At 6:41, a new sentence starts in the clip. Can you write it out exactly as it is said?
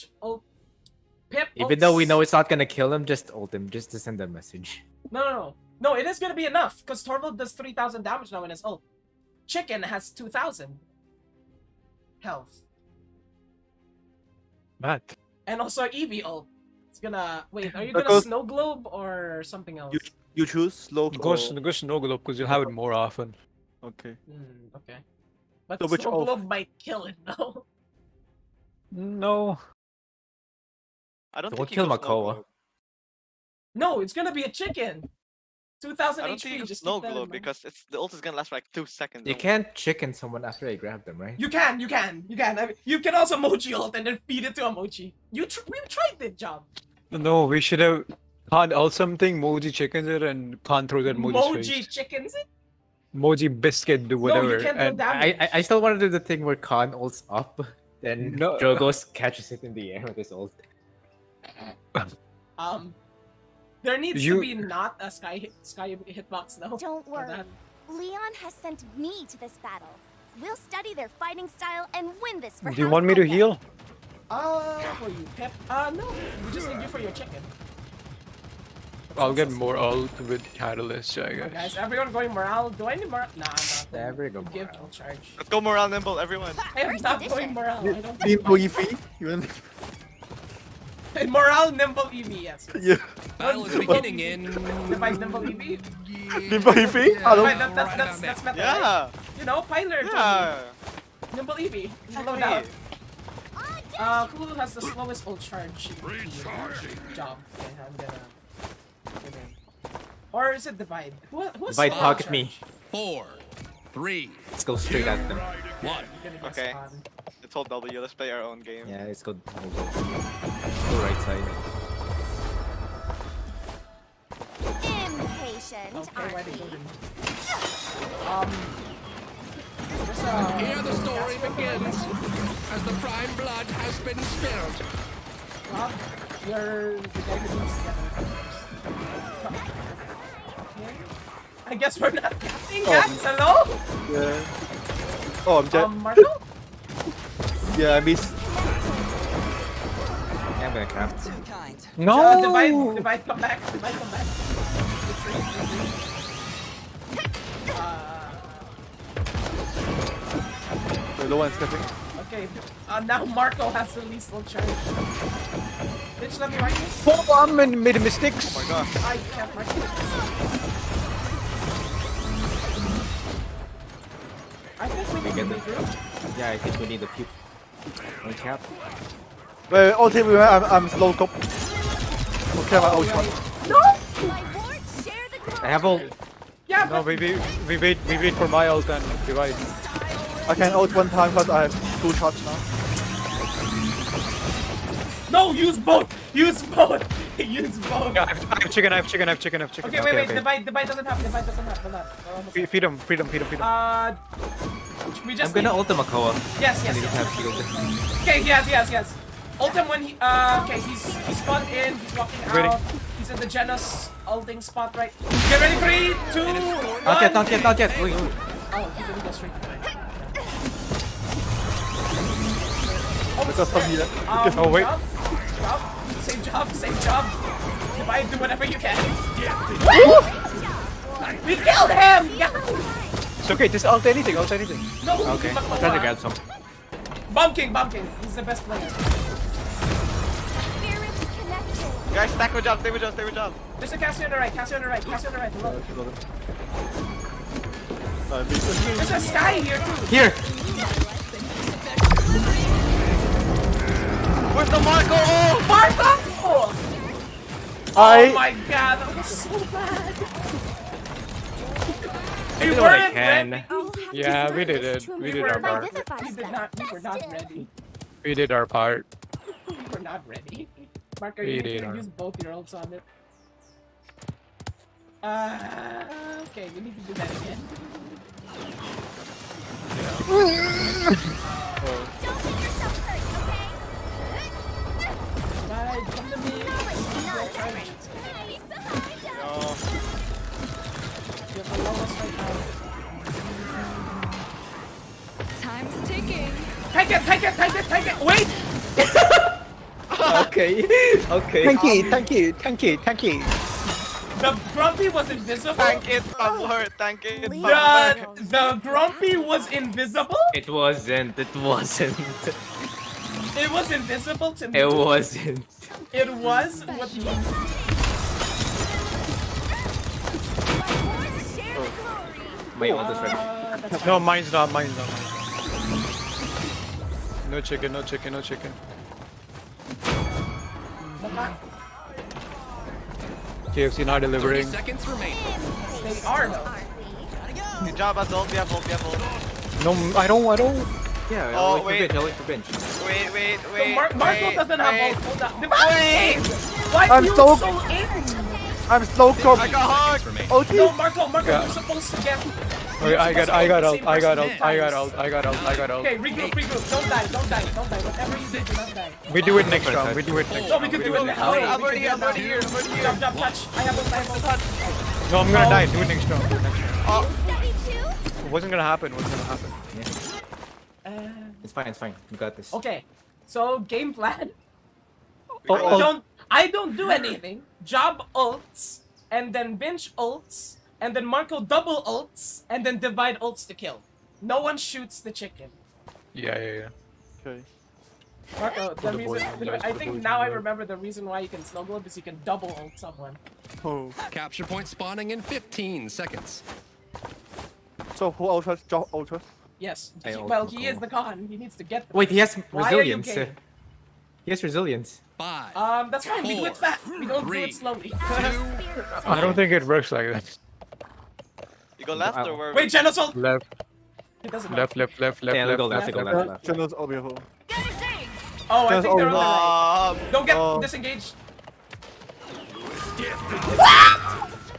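He needs to get the Wait, he has resilience.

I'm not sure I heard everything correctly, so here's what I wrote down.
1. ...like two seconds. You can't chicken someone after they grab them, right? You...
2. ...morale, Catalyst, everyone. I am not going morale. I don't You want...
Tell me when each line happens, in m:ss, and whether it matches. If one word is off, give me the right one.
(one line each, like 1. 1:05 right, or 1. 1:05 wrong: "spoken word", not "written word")
1. 0:38 right
2. 1:25 wrong: "Nimble", not "Catalyst".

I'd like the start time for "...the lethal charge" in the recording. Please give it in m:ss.
2:43.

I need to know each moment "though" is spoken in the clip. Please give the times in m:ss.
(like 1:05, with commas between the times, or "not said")
0:01, 0:27, 1:06, 5:36.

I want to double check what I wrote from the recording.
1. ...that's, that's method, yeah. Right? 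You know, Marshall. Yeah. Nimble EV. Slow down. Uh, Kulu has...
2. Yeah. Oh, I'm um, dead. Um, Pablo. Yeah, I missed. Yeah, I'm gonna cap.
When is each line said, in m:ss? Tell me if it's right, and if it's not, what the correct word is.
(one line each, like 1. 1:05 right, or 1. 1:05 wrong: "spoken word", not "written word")
1. 1:37 wrong: "Pyler", not "Marshall"
2. 2:24 wrong: "Marshall", not "Pablo".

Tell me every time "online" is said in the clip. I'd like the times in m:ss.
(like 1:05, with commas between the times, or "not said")
not said.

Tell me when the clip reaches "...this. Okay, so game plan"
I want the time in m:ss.
6:12.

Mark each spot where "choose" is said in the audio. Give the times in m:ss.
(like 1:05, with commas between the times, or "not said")
0:20.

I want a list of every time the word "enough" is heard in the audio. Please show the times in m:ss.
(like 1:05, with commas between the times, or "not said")
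0:06.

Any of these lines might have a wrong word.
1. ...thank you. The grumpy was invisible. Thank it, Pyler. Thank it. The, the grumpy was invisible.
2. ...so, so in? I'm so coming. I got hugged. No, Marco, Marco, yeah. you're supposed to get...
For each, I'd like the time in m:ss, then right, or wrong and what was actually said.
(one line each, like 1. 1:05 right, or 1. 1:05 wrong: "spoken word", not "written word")
1. 5:02 wrong: "Pablo", not "Pyler"
2. 5:47 right.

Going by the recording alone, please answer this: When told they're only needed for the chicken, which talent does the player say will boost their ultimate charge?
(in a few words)
Catalyst.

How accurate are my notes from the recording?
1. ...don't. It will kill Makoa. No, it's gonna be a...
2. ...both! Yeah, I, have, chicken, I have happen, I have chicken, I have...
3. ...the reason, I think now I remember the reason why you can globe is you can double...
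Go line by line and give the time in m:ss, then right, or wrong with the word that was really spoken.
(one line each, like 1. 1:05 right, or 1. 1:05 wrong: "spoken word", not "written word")
1. 0:31 right
2. 3:17 wrong: "chicken", not "happen"
3. 6:28 right.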